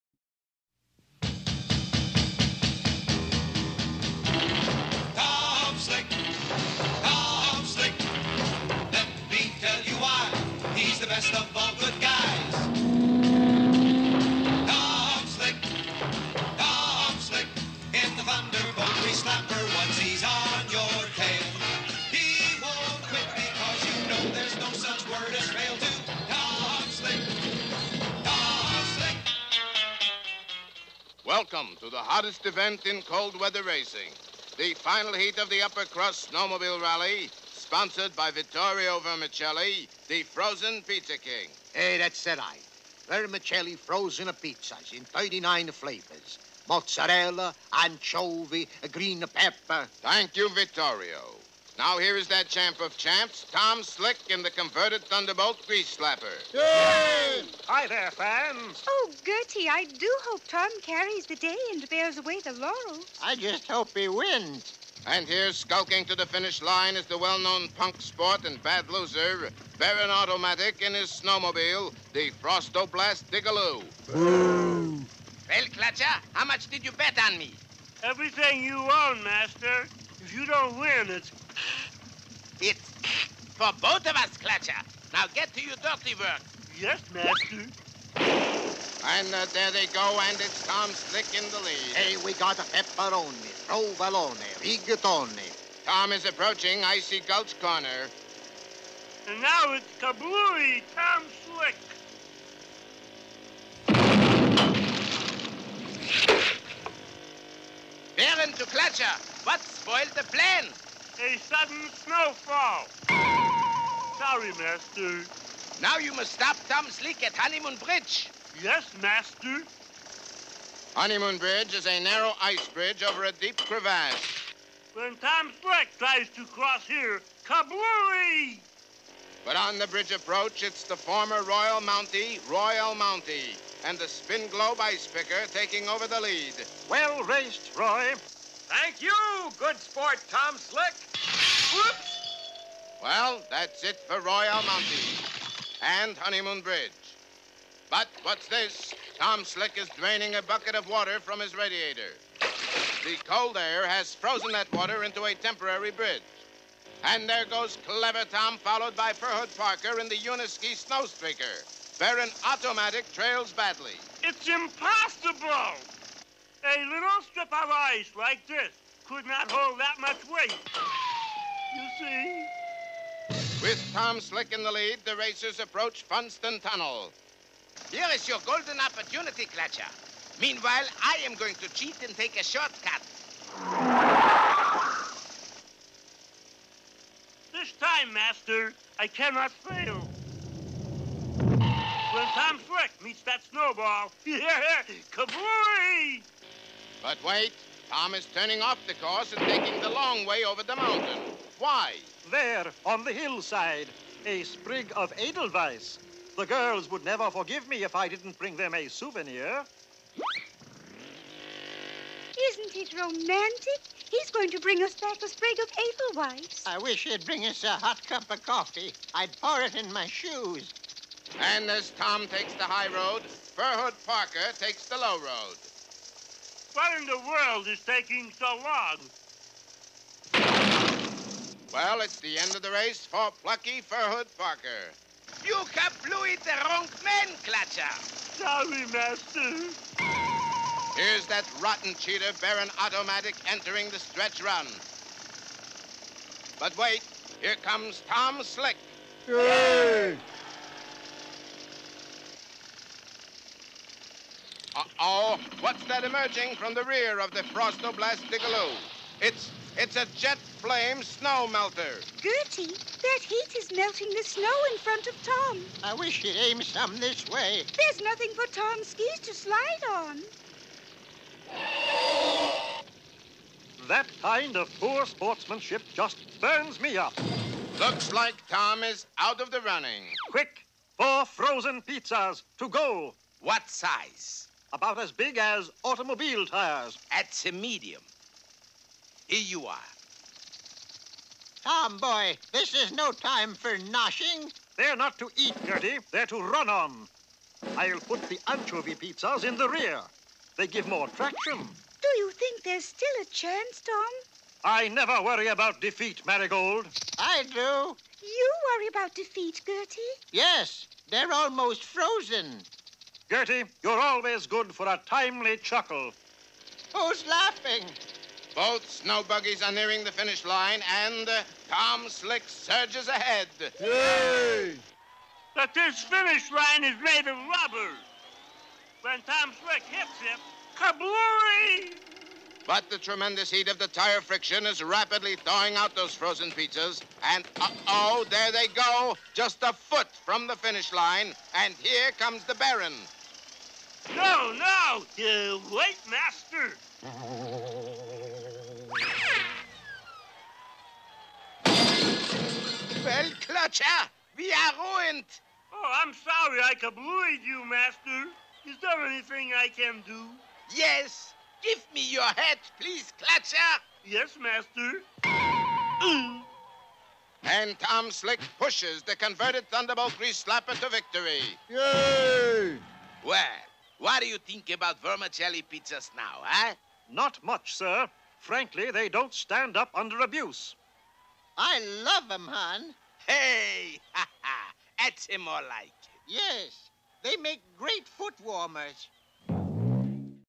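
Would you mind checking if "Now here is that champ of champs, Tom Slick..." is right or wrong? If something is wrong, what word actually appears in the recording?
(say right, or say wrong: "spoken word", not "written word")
right.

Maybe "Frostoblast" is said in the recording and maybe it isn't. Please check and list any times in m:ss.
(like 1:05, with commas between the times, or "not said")
1:12, 4:17.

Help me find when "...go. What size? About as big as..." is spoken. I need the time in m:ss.
4:42.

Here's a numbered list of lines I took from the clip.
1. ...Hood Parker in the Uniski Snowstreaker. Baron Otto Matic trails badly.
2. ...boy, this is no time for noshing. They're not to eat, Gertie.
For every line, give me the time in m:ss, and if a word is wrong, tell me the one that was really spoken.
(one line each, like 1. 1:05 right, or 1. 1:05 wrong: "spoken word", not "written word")
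1. 2:39 right
2. 4:51 right.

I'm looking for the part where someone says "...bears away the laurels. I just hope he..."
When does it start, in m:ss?
1:01.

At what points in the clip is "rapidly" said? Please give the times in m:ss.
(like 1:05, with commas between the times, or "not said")
5:34.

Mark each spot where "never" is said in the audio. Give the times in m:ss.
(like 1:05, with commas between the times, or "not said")
3:27, 5:04.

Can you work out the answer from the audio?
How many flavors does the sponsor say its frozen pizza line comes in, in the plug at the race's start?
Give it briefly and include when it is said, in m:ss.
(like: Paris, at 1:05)
39, at 0:45.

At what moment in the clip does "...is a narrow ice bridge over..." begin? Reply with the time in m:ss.
2:01.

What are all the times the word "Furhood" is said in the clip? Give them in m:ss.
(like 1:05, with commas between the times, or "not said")
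3:43, 3:53.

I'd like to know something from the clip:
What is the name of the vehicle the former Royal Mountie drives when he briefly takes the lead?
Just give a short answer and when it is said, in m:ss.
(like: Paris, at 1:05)
Spin Globe Ice Picker, at 2:14.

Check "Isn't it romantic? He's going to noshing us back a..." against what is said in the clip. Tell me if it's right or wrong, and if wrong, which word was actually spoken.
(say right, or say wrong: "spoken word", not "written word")
wrong: "bring", not "noshing".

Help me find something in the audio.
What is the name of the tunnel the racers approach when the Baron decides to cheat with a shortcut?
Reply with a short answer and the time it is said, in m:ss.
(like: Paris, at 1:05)
Funston Tunnel, at 2:56.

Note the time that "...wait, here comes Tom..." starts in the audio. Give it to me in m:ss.
4:06.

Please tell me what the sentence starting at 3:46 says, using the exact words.
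What in the world is taking so long?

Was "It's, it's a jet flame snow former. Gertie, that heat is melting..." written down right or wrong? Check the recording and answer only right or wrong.
wrong.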